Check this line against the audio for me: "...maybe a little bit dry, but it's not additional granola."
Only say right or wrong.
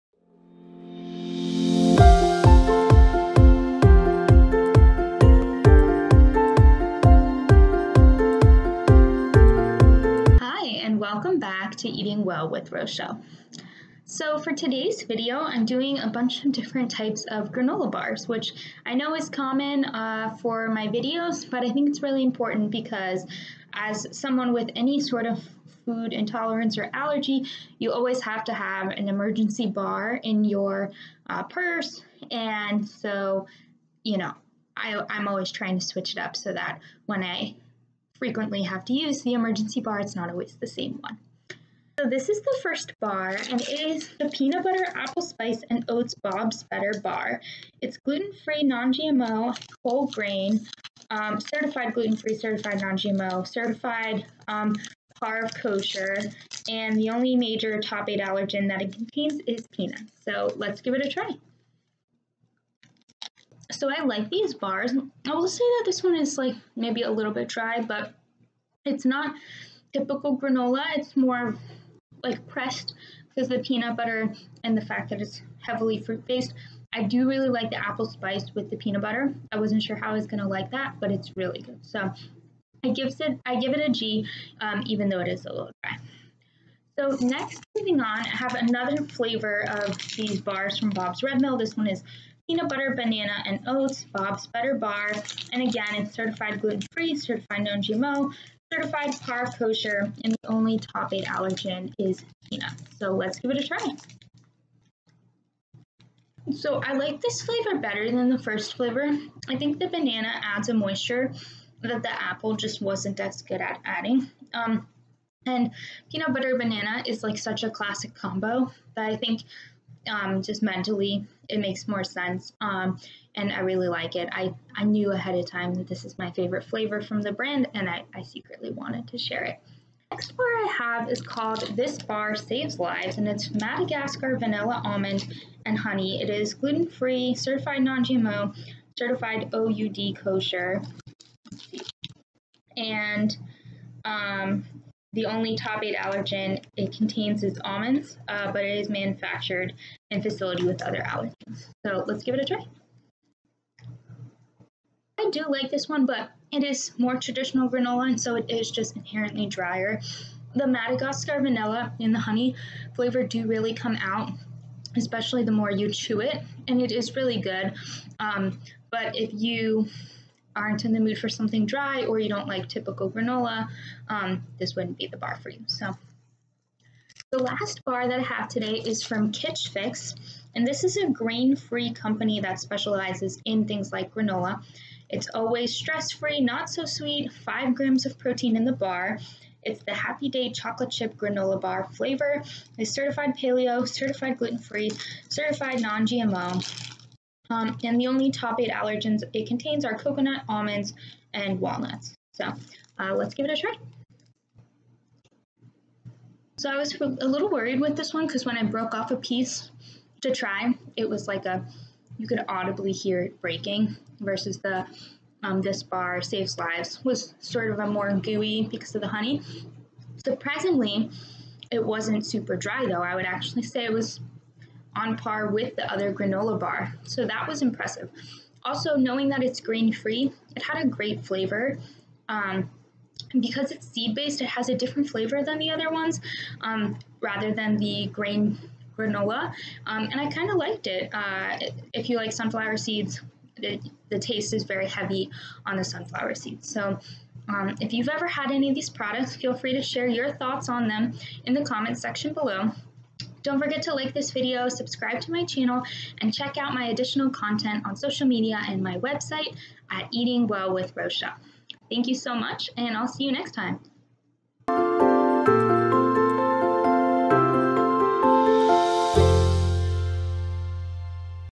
wrong.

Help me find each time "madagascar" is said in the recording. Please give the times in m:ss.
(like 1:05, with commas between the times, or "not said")
2:13, 2:40.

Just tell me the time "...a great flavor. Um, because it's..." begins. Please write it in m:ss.
3:50.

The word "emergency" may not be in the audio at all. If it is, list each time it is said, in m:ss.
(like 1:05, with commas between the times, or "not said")
0:29, 0:39.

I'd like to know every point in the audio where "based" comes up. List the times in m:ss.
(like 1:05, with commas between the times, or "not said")
1:16, 3:54.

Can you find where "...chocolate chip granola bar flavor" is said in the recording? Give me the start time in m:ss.
3:10.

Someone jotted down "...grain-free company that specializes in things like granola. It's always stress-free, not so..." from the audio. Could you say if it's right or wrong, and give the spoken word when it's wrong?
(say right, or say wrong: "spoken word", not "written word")
right.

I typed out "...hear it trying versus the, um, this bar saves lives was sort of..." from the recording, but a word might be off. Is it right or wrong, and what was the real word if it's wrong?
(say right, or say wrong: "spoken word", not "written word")
wrong: "breaking", not "trying".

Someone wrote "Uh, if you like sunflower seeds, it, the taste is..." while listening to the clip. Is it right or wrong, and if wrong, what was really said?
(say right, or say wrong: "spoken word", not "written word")
right.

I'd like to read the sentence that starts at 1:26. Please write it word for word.
So next, moving on, I have another flavor of these bars from Bob's Red Mill.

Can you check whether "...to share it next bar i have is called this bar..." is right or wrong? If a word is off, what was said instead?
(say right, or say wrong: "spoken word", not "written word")
right.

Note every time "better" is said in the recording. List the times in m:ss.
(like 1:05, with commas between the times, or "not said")
0:46, 1:34, 1:47.